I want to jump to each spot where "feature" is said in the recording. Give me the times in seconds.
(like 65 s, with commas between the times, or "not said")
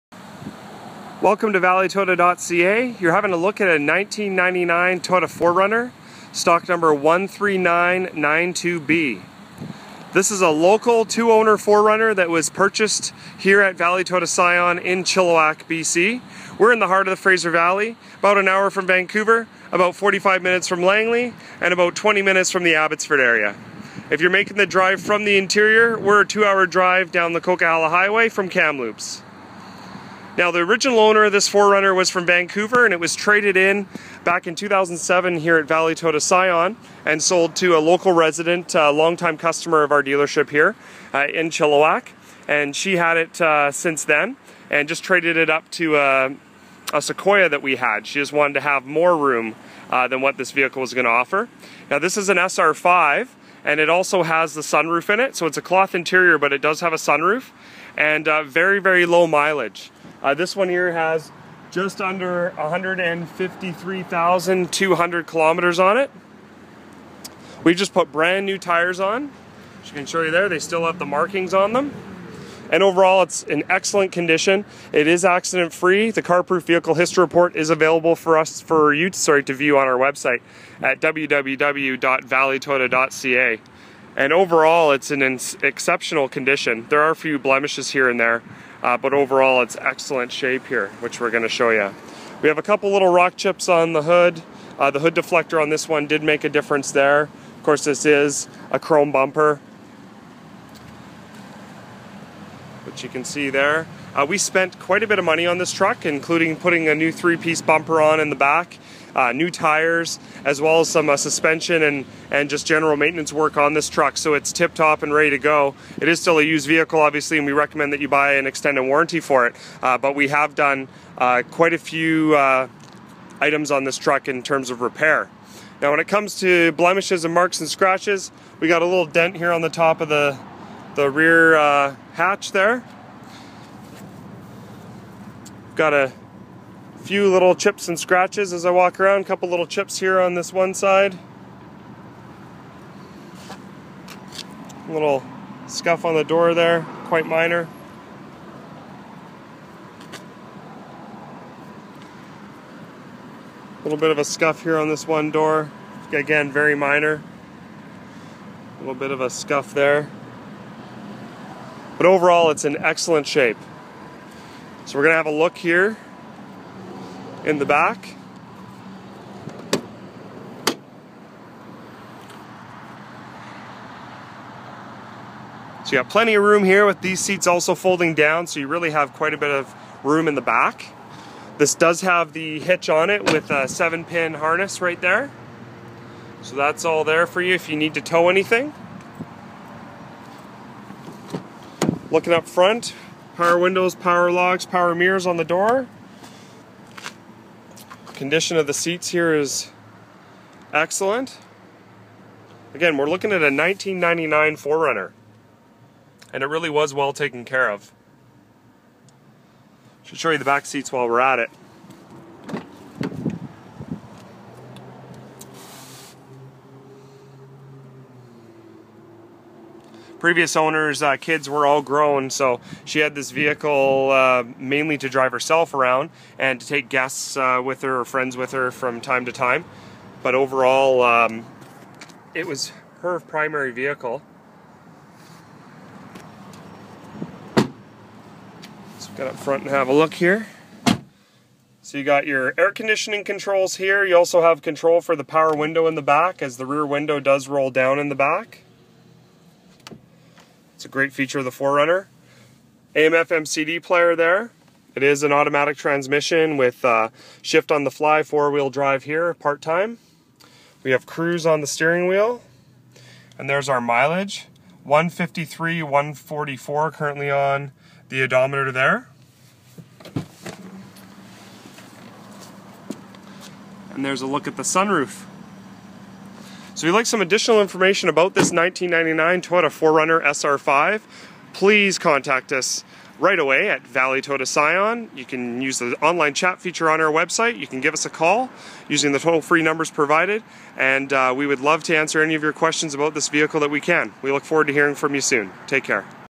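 251 s, 286 s.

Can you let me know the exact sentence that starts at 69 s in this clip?
As you can show you there, they still have the markings on them.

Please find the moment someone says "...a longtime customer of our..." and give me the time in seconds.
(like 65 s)
38 s.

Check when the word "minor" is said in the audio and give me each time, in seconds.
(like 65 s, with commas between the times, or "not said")
147 s, 156 s.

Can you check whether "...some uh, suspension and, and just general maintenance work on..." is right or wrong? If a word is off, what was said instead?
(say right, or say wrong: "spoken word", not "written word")
right.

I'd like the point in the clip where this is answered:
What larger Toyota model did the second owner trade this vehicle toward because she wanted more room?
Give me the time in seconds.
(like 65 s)
47 s.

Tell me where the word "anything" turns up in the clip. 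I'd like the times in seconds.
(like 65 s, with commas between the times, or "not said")
188 s.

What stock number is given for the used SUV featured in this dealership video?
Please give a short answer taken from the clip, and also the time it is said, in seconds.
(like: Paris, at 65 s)
13992B, at 6 s.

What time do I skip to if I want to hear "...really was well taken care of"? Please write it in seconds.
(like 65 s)
206 s.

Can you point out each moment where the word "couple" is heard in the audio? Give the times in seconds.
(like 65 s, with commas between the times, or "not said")
92 s, 139 s.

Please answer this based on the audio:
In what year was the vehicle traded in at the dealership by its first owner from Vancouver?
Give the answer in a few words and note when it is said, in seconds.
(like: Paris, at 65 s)
2007, at 34 s.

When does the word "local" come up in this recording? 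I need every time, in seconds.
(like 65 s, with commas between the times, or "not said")
10 s, 37 s.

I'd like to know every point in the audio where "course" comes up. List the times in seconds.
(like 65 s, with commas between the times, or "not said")
97 s.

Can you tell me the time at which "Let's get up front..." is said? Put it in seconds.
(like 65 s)
237 s.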